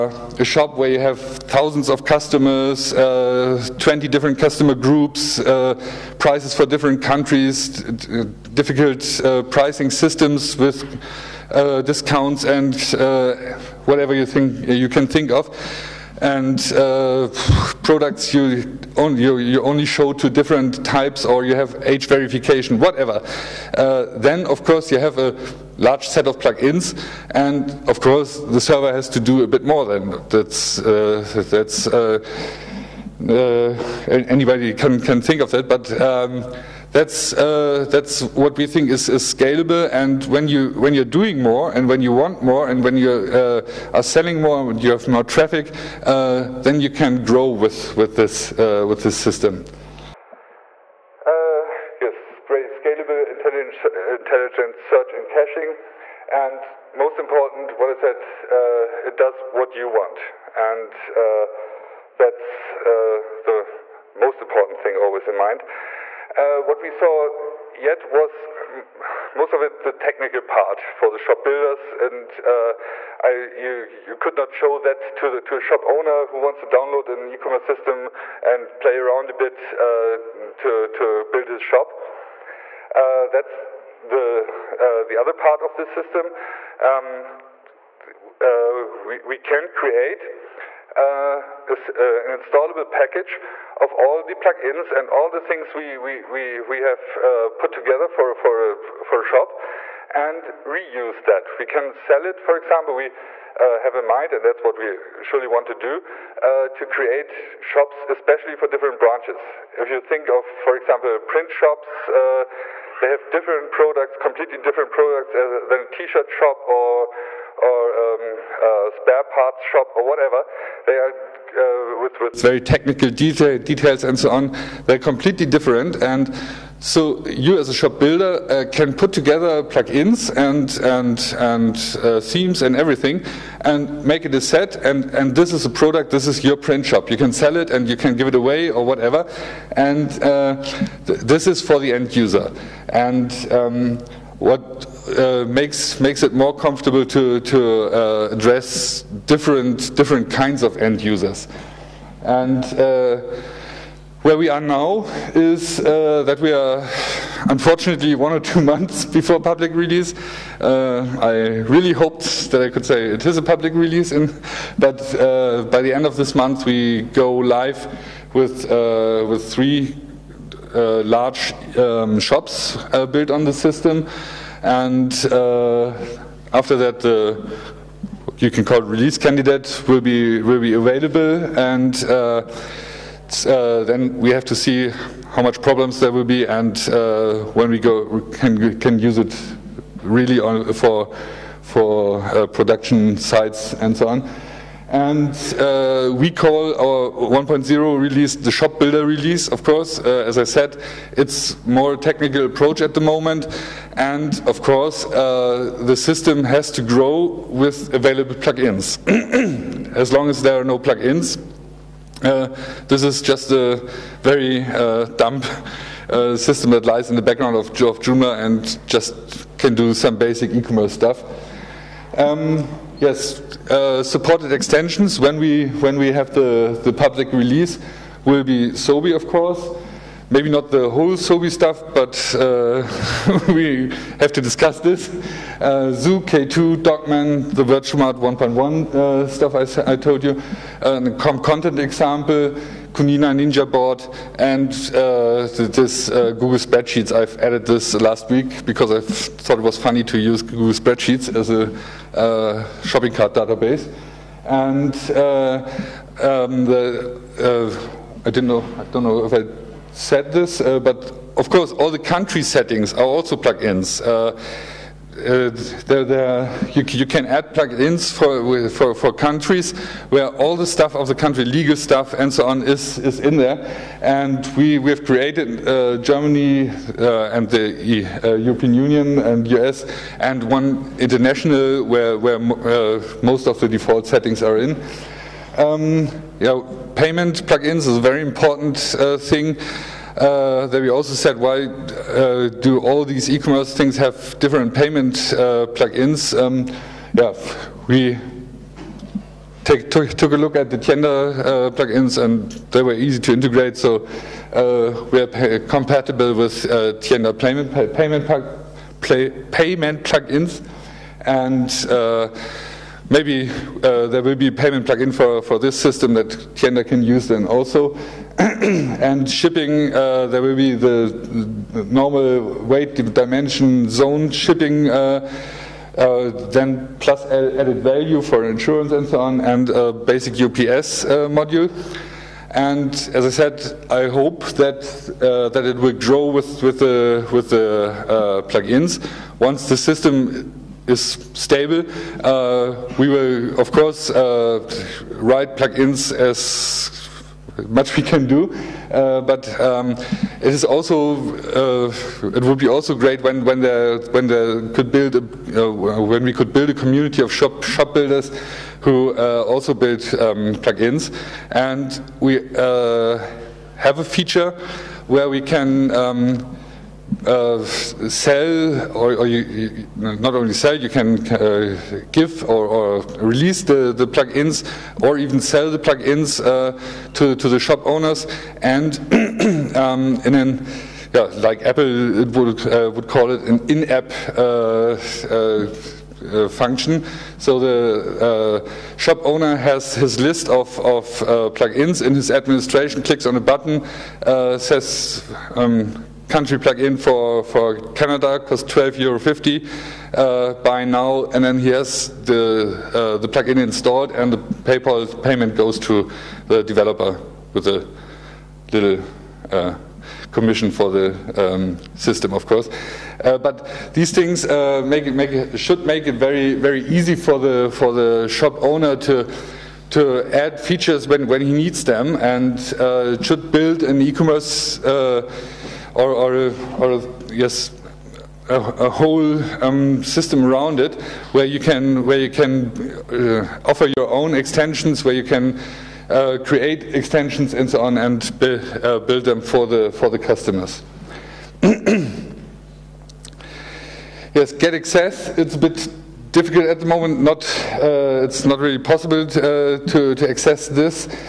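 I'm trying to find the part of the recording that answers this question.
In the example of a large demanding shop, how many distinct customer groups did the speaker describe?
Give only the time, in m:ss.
0:03.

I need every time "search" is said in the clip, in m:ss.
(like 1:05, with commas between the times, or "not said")
0:54.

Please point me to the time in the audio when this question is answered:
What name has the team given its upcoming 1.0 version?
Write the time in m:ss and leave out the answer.
3:18.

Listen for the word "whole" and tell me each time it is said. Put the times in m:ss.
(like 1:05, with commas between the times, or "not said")
3:50, 7:08.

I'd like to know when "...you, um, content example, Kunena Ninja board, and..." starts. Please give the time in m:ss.
4:00.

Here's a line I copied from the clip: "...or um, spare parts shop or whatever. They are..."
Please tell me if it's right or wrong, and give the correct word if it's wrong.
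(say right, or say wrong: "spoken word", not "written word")
right.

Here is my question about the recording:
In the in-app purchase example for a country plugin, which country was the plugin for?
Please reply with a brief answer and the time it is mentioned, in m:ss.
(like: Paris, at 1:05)
Canada, at 6:37.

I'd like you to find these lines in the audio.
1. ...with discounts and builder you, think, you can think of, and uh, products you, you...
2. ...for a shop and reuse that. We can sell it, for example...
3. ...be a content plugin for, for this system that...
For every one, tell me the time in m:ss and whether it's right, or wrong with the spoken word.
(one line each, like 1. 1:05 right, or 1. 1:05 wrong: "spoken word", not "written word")
1. 0:10 wrong: "whatever", not "builder"
2. 1:39 right
3. 5:14 wrong: "payment", not "content".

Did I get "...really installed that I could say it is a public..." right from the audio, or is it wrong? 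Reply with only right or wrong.
wrong.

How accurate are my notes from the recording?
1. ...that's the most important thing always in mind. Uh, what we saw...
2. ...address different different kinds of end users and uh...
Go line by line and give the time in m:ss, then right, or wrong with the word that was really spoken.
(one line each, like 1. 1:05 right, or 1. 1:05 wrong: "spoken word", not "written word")
1. 1:02 right
2. 2:28 right.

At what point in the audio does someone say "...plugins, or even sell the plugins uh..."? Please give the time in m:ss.
6:14.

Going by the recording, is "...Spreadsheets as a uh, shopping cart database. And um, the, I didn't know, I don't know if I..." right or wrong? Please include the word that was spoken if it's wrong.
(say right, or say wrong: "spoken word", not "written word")
right.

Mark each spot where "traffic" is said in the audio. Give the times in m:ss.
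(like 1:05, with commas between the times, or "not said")
0:45.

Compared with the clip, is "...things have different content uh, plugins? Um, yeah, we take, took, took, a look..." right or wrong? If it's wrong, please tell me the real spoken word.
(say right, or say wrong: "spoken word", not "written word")
wrong: "payment", not "content".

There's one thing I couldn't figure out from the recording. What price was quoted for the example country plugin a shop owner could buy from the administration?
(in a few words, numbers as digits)
12.50 euros.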